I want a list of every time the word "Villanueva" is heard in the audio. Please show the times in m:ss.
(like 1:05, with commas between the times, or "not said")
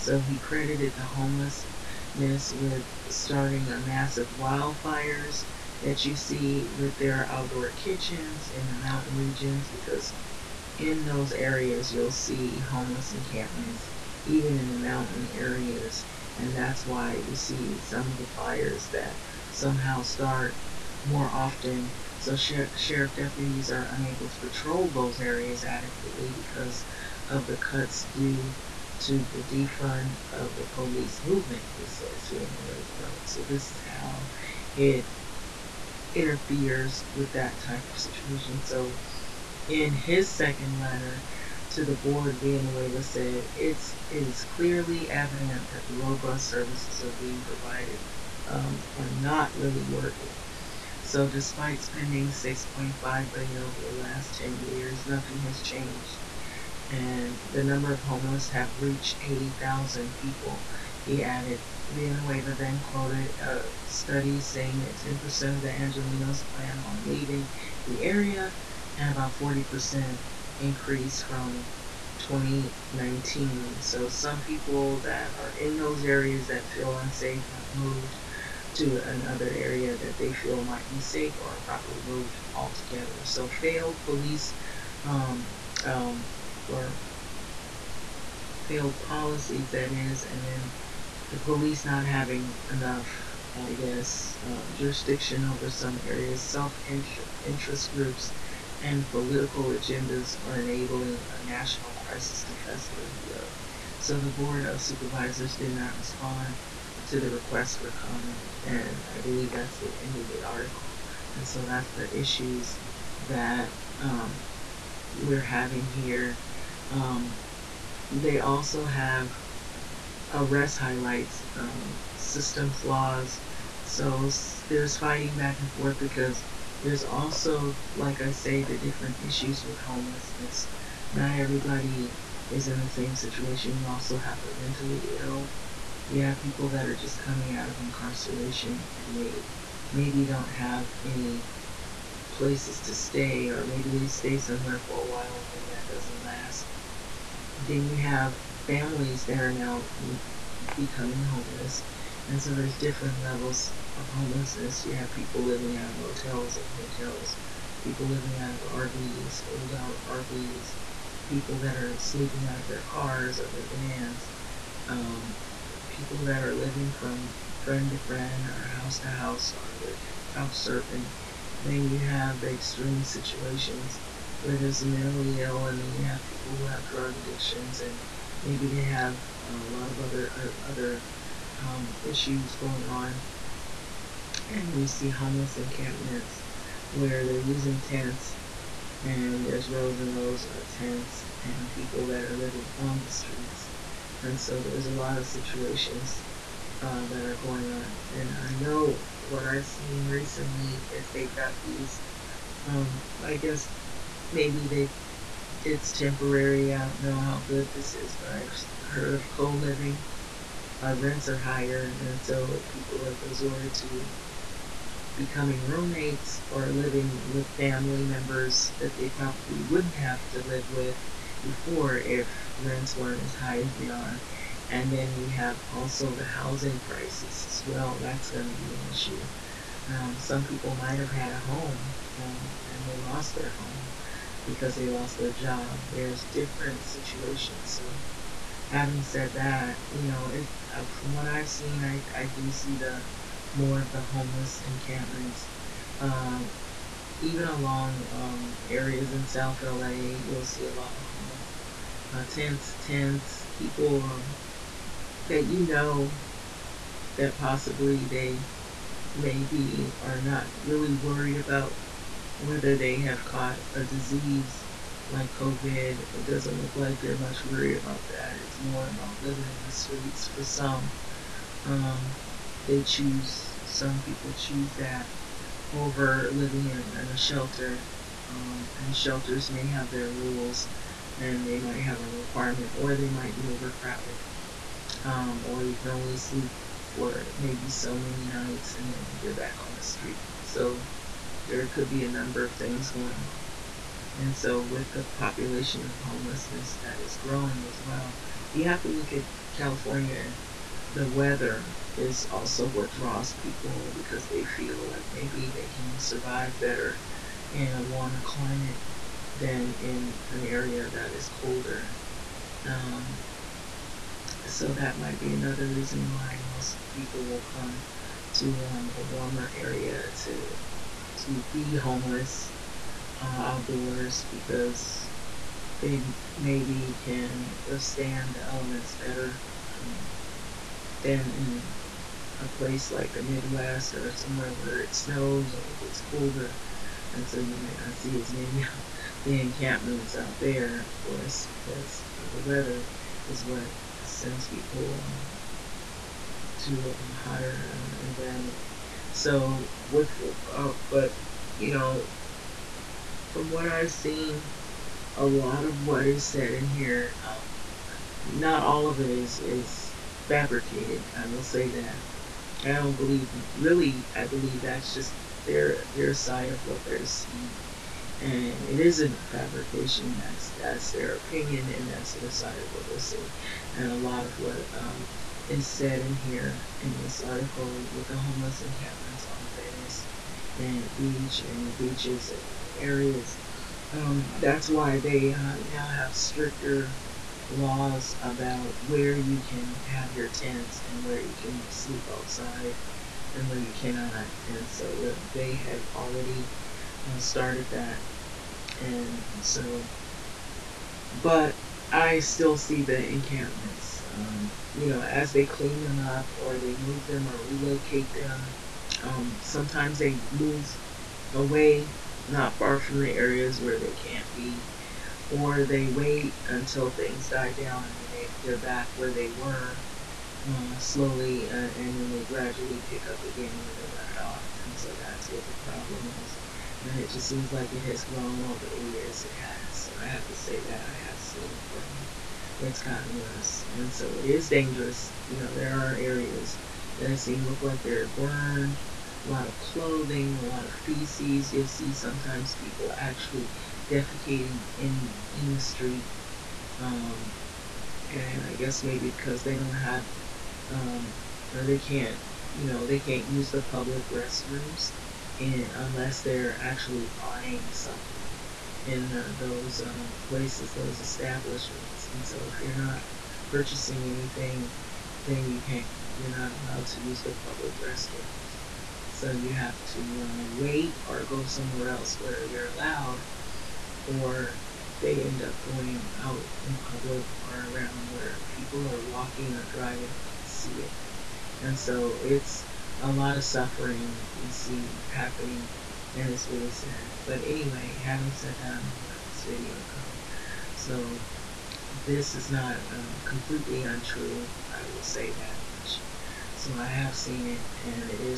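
0:42, 1:01.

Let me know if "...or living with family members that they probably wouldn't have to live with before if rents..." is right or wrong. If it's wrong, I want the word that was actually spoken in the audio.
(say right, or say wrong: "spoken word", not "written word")
right.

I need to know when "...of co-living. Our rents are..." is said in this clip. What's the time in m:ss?
3:29.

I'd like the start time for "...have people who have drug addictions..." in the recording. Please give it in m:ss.
2:56.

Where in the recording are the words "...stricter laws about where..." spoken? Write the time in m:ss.
6:26.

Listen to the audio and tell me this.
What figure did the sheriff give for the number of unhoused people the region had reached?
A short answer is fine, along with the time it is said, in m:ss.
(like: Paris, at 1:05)
80,000, at 0:59.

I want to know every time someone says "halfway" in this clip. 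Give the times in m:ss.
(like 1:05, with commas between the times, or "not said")
not said.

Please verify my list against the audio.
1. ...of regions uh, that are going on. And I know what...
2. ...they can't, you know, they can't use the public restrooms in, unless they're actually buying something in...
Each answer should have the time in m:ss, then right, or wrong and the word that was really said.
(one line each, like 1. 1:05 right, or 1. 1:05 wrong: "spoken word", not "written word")
1. 3:15 wrong: "situations", not "regions"
2. 7:31 right.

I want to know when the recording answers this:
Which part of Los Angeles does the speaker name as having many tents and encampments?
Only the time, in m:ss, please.
4:09.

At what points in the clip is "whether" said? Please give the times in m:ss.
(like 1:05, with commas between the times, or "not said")
4:22.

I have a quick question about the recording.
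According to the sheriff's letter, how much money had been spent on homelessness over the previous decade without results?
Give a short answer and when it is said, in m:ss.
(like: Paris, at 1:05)
6.5 billion, at 0:52.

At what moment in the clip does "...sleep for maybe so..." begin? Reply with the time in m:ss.
4:46.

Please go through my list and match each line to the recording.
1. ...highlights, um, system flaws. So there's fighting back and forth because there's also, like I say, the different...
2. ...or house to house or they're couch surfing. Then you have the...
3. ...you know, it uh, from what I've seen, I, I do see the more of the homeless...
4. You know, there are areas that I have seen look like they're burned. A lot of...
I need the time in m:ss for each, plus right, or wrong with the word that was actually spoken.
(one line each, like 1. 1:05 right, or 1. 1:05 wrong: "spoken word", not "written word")
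1. 2:00 right
2. 2:48 right
3. 3:59 right
4. 7:15 right.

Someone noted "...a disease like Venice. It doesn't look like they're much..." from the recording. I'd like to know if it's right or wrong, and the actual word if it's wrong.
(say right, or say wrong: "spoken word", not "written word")
wrong: "COVID", not "Venice".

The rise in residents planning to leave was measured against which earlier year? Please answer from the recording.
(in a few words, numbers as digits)
2019.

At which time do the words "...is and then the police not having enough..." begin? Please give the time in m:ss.
1:29.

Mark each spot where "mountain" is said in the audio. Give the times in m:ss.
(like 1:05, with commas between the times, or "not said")
0:08, 0:14.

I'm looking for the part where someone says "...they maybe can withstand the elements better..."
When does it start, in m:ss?
5:25.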